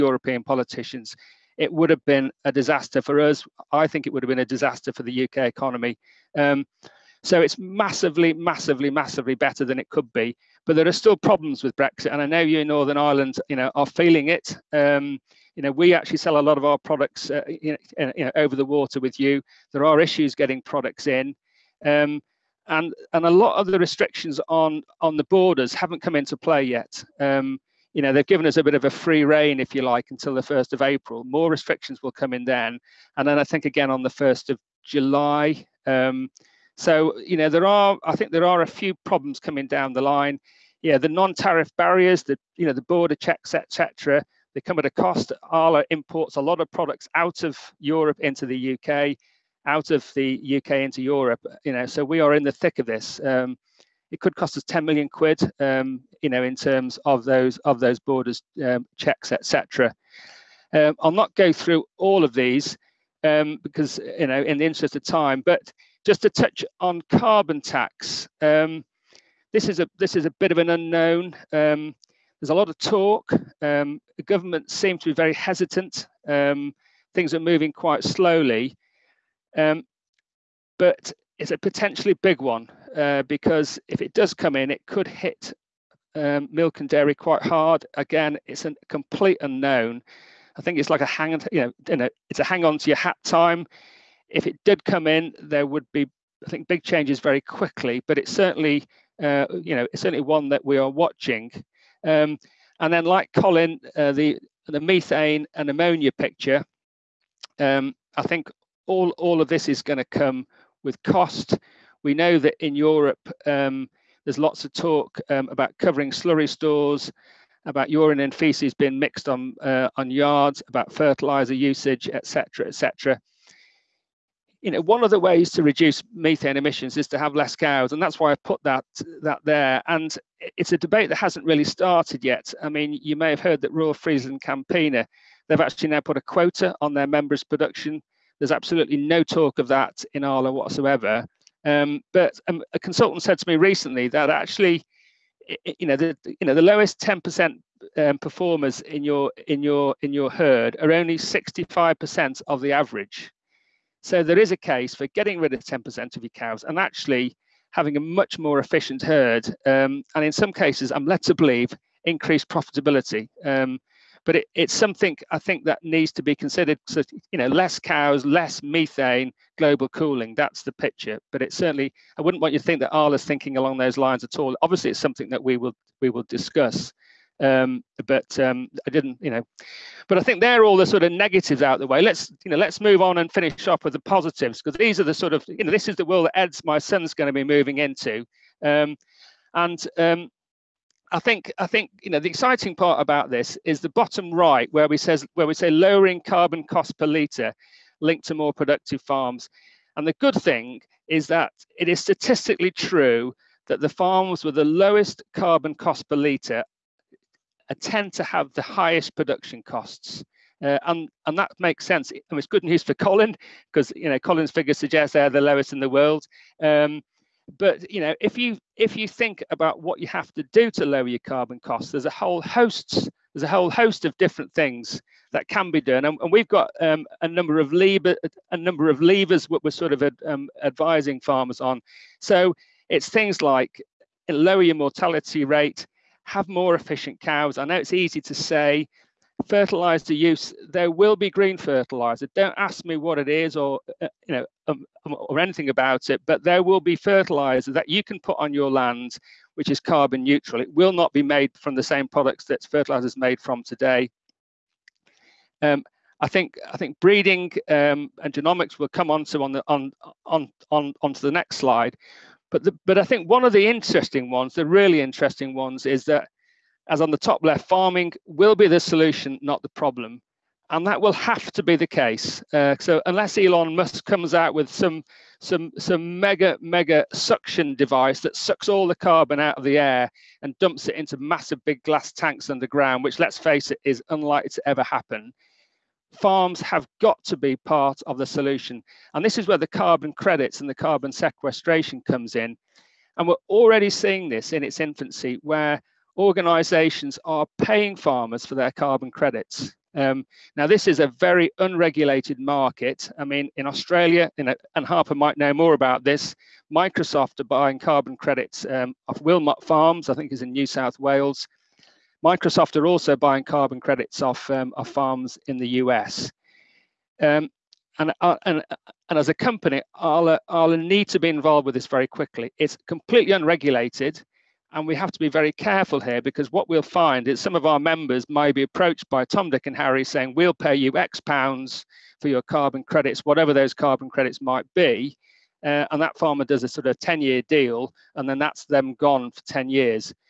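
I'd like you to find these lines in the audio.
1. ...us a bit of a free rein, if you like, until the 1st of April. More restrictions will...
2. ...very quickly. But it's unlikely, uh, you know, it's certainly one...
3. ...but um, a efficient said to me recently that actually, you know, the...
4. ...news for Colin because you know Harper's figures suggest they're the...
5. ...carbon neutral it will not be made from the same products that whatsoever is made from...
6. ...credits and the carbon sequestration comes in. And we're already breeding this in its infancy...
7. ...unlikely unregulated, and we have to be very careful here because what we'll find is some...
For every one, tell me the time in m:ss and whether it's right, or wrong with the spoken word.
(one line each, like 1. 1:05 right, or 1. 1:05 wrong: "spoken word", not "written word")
1. 0:28 right
2. 1:37 wrong: "certainly", not "unlikely"
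3. 2:22 wrong: "consultant", not "efficient"
4. 3:32 wrong: "Colin", not "Harper"
5. 4:09 wrong: "fertilizer", not "whatsoever"
6. 4:50 wrong: "seeing", not "breeding"
7. 5:22 wrong: "completely", not "unlikely".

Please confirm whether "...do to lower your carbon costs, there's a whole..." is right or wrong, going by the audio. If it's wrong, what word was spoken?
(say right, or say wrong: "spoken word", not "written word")
right.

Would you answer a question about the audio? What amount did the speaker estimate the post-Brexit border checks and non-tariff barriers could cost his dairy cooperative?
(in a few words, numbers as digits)
10 million quid.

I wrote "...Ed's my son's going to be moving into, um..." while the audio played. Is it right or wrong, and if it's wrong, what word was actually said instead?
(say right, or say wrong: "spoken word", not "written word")
right.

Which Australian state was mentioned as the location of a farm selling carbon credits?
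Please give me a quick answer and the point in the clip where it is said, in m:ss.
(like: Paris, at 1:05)
New South Wales, at 5:10.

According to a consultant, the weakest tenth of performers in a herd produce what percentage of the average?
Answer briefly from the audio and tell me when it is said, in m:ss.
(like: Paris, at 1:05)
65%, at 2:31.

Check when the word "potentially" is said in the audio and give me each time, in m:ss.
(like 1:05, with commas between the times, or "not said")
1:21.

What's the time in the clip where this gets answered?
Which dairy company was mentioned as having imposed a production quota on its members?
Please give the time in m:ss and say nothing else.
2:13.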